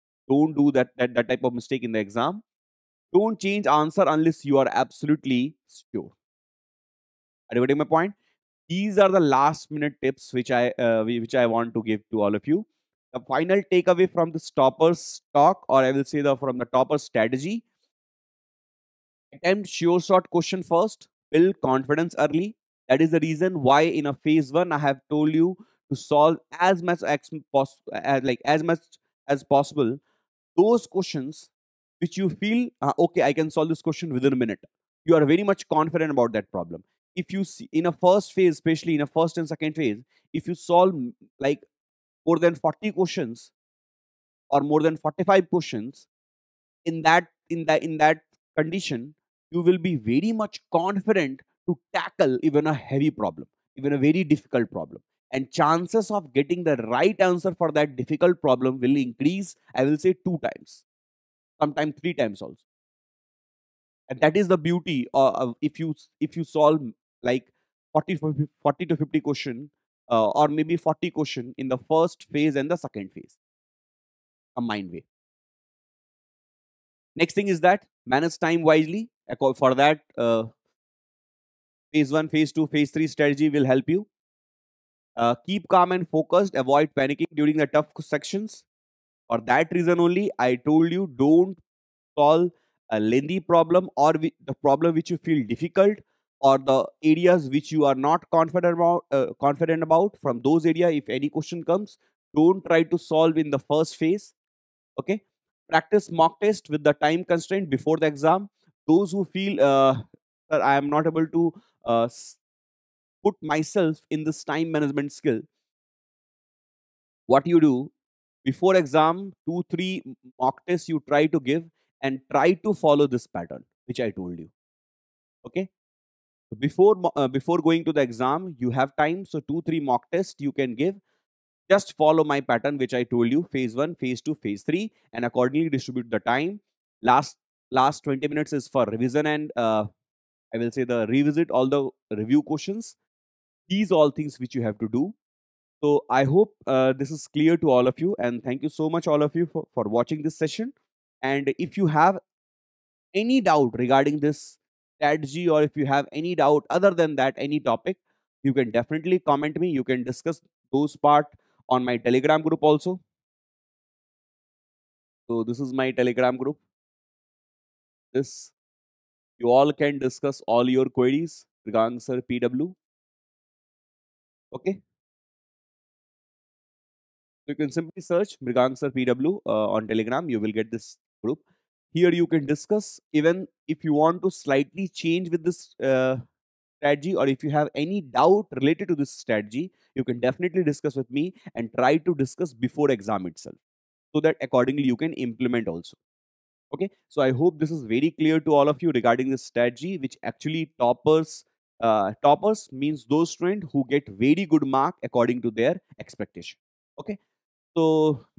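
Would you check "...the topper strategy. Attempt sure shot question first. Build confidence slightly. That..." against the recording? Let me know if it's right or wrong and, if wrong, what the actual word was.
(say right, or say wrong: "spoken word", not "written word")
wrong: "early", not "slightly".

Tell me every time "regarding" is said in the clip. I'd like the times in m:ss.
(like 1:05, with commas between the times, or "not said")
2:33, 2:51, 3:18.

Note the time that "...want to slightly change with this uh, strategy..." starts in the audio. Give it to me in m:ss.
3:03.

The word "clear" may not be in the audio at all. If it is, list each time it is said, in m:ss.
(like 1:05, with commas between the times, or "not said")
2:27, 3:18.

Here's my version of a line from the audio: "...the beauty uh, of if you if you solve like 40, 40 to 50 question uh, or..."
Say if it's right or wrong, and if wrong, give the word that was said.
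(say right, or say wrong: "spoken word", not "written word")
right.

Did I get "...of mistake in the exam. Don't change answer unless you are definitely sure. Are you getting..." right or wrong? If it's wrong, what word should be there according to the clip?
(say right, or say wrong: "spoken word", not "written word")
wrong: "absolutely", not "definitely".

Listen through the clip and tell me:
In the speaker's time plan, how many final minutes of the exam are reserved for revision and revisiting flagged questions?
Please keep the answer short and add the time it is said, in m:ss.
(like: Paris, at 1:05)
20 minutes, at 2:18.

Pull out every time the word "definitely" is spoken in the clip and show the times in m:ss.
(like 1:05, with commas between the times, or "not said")
2:38, 3:10.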